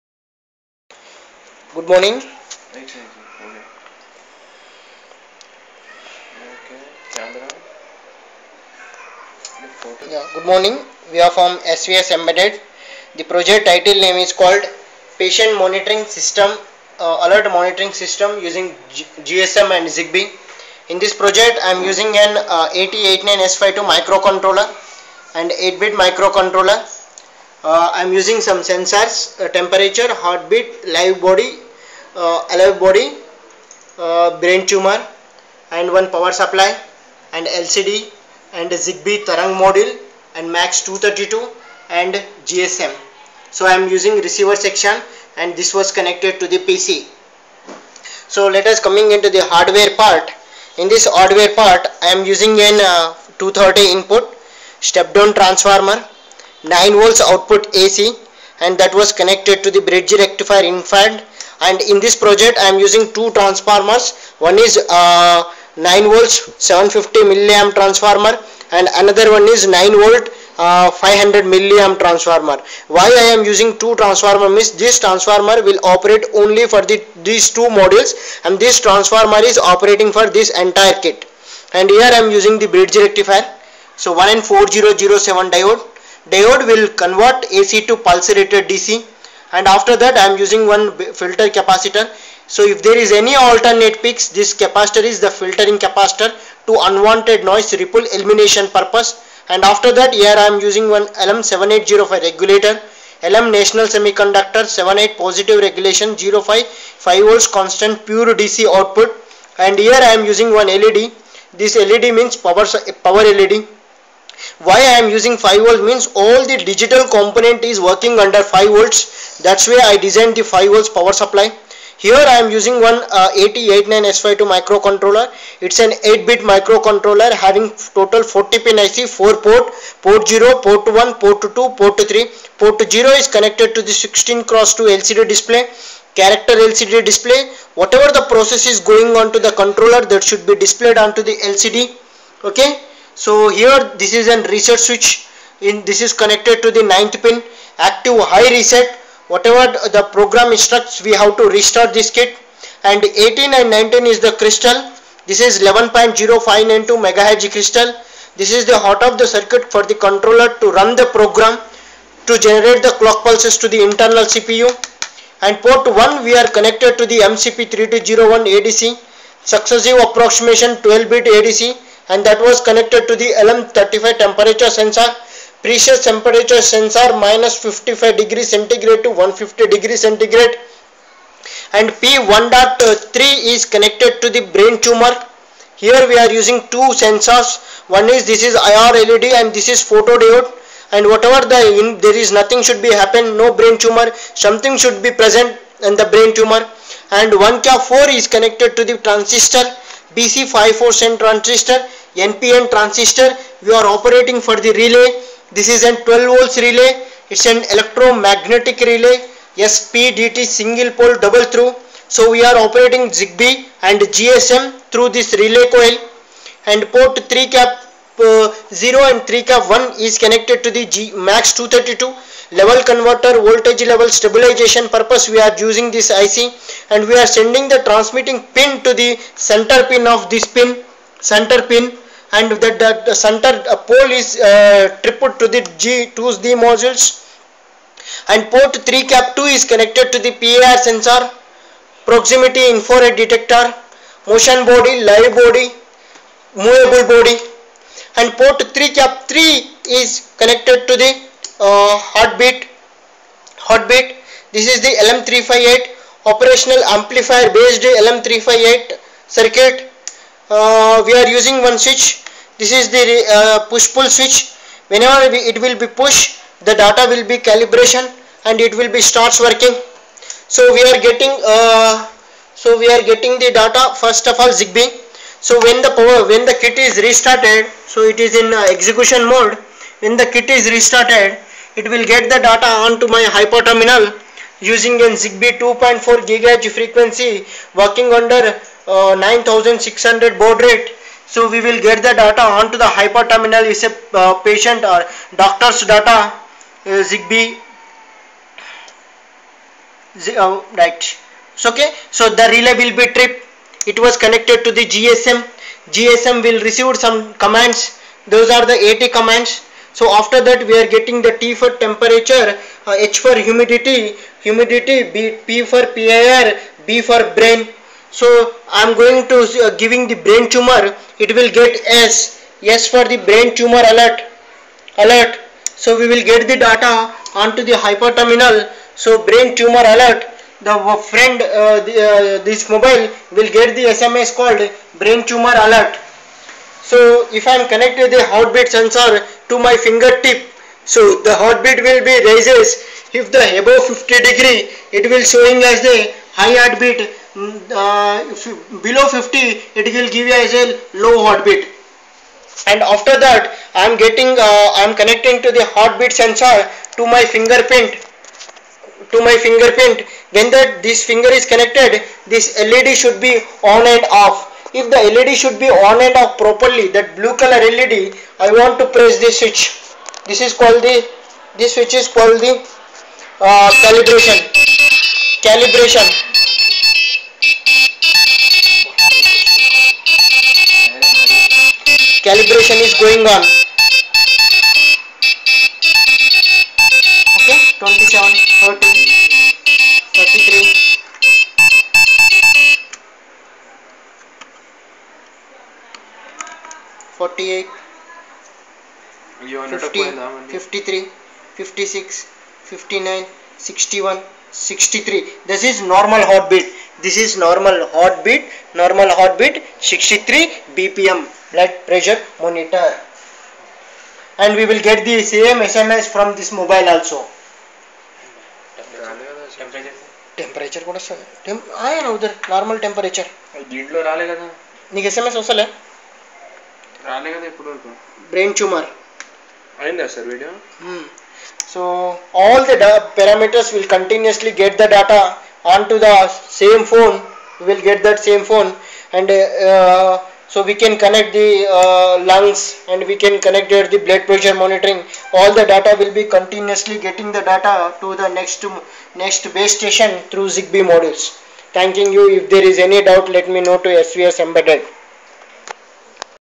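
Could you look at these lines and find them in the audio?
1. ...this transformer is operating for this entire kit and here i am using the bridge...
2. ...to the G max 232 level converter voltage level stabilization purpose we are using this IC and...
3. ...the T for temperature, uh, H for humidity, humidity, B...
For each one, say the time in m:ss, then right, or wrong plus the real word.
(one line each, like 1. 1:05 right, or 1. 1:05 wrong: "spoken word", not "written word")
1. 1:18 right
2. 3:40 right
3. 5:11 right.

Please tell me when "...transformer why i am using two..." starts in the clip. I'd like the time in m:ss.
1:12.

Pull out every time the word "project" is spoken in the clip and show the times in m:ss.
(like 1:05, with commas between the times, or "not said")
0:13, 0:21, 1:02.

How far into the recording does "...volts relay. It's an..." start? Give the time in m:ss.
3:26.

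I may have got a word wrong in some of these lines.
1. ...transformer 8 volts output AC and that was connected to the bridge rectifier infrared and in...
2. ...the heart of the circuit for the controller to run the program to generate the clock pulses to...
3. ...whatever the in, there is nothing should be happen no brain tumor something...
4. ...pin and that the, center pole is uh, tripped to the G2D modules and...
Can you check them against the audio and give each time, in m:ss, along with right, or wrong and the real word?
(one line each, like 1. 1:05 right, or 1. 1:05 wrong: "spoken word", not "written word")
1. 0:55 wrong: "9", not "8"
2. 2:38 right
3. 3:11 right
4. 3:51 right.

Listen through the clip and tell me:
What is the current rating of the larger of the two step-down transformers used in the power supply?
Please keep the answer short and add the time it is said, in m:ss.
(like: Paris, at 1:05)
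750 mA, at 1:06.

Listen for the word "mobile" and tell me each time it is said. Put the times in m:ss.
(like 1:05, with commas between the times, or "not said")
5:32, 6:56.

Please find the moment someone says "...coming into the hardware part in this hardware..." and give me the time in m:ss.
0:48.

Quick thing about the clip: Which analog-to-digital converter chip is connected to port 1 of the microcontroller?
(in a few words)
MCP3201.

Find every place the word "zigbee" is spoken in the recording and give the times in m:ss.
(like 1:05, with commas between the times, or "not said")
0:19, 0:38, 3:33, 4:34, 4:45, 4:57, 7:30.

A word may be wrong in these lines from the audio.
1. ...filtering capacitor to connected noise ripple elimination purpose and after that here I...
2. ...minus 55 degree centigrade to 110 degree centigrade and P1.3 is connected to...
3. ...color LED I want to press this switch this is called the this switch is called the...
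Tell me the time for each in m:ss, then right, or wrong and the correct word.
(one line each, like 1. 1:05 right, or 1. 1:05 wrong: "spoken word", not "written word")
1. 1:35 wrong: "unwanted", not "connected"
2. 2:57 wrong: "150", not "110"
3. 6:07 right.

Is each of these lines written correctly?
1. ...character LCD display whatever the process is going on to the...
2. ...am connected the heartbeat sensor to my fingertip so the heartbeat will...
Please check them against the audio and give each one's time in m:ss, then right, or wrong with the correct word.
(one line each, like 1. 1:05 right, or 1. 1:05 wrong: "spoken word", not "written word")
1. 2:16 right
2. 5:37 right.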